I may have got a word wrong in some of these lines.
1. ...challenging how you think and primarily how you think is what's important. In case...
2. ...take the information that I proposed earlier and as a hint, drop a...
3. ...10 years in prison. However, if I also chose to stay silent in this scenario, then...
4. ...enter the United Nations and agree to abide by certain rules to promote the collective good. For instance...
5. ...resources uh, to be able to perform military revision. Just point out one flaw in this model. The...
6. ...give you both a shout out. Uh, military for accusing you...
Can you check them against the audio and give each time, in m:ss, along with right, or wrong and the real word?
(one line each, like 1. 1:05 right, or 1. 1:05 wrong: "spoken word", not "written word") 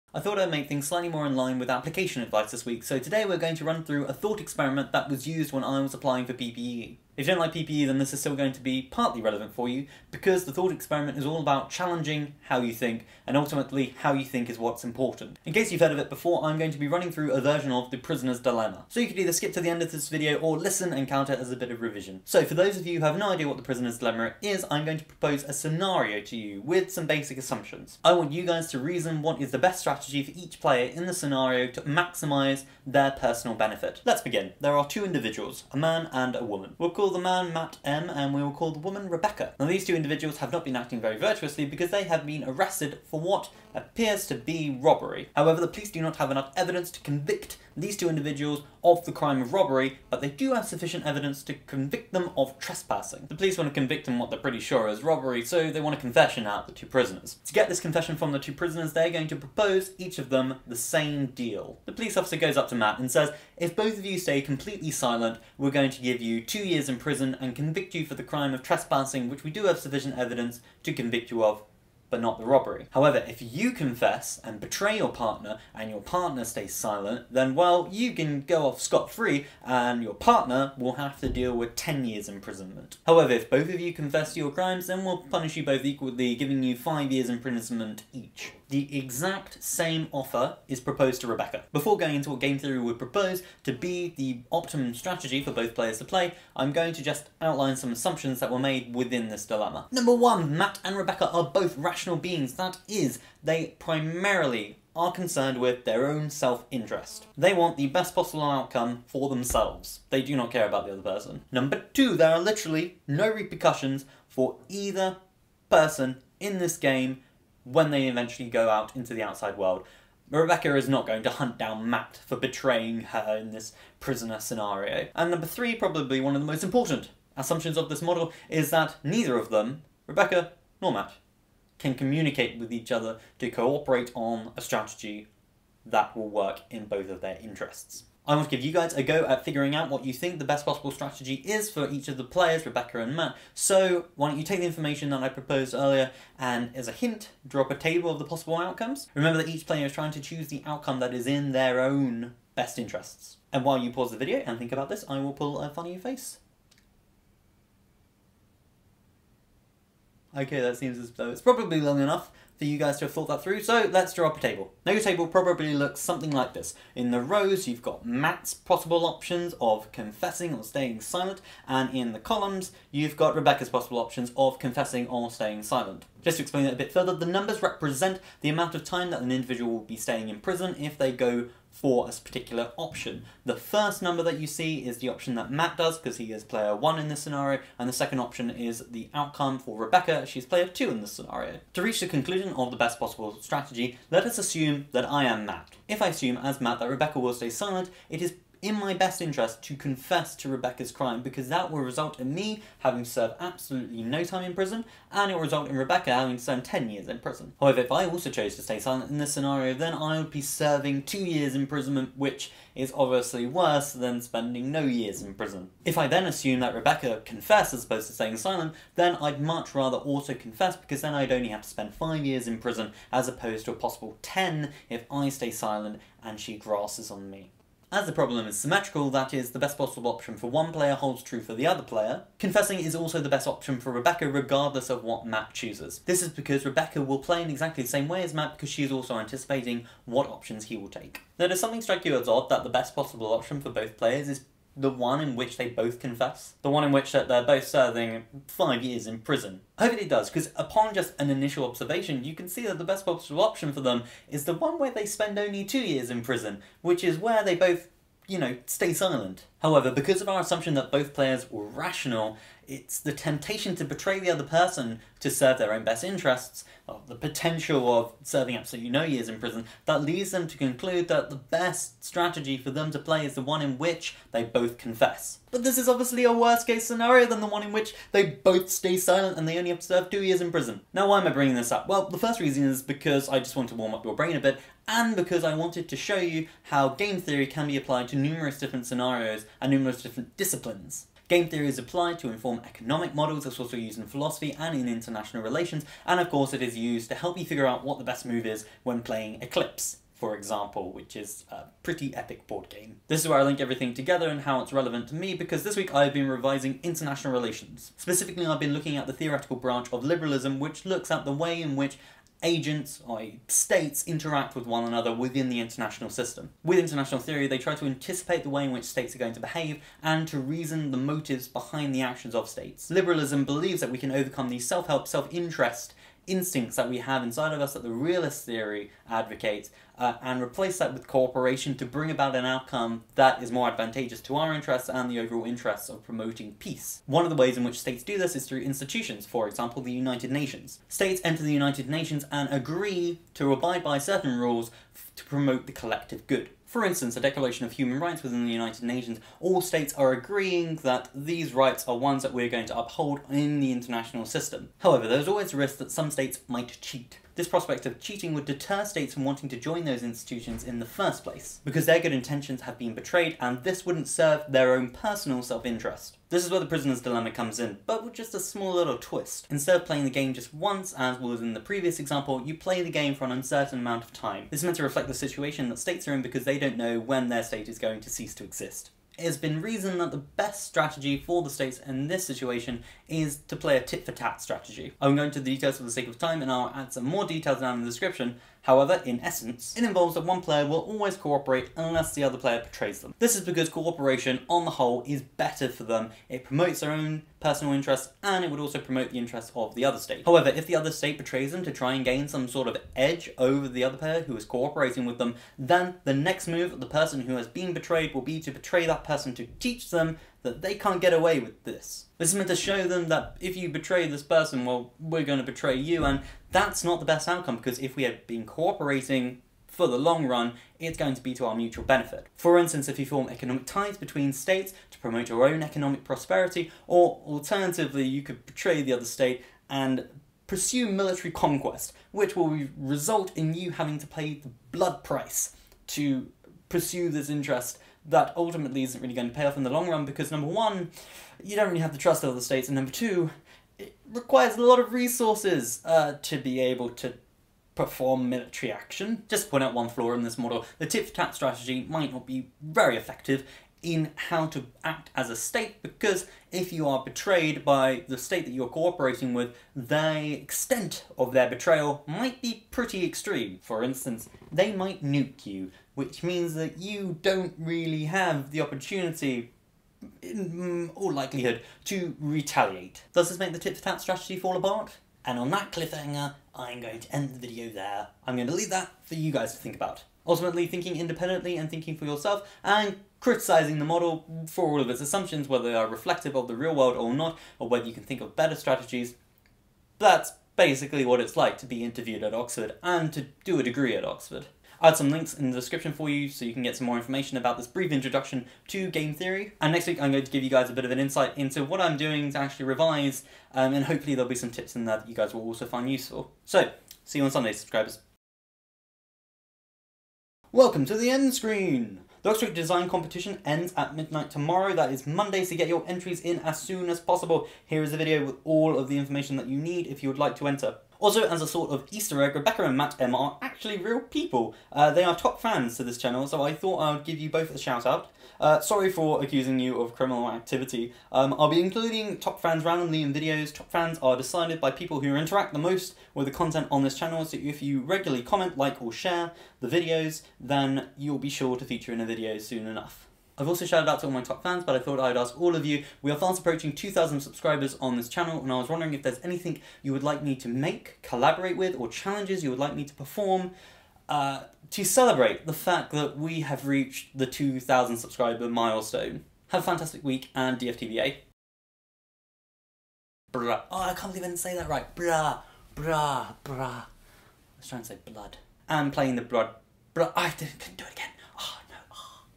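1. 0:11 wrong: "ultimately", not "primarily"
2. 2:24 right
3. 3:26 right
4. 5:41 right
5. 7:24 wrong: "action", not "revision"
6. 8:47 wrong: "sorry", not "military".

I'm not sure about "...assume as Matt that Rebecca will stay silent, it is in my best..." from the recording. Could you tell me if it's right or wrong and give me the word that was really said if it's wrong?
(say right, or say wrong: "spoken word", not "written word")
right.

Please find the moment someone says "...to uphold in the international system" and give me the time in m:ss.
5:52.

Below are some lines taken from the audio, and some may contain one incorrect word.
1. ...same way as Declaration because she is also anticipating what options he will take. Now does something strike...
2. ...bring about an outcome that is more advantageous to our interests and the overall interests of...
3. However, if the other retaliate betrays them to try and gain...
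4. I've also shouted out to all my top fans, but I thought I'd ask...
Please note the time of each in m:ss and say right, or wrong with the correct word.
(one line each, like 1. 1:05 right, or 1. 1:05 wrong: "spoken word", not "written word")
1. 3:57 wrong: "Matt", not "Declaration"
2. 5:31 right
3. 6:40 wrong: "state", not "retaliate"
4. 9:03 right.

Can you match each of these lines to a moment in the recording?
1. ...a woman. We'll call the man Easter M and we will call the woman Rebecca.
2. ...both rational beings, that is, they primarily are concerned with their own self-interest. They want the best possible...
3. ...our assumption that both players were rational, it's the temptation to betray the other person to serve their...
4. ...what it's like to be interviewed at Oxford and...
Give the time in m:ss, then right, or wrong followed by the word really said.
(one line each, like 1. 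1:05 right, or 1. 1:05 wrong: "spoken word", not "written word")
1. 0:36 wrong: "Matt", not "Easter"
2. 1:41 right
3. 4:20 right
4. 8:11 right.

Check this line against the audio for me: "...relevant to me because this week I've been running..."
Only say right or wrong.
wrong.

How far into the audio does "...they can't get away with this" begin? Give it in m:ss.
6:50.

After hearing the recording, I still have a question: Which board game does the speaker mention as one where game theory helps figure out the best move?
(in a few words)
Eclipse.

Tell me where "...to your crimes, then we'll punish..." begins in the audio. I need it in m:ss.
1:24.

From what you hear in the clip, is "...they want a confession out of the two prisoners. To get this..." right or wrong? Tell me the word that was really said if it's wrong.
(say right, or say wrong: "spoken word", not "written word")
right.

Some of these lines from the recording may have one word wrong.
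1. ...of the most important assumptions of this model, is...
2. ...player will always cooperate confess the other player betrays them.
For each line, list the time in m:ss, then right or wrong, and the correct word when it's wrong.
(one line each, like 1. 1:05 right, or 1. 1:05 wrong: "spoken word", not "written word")
1. 2:06 right
2. 6:30 wrong: "unless", not "confess".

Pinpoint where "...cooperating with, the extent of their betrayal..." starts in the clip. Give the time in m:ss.
7:38.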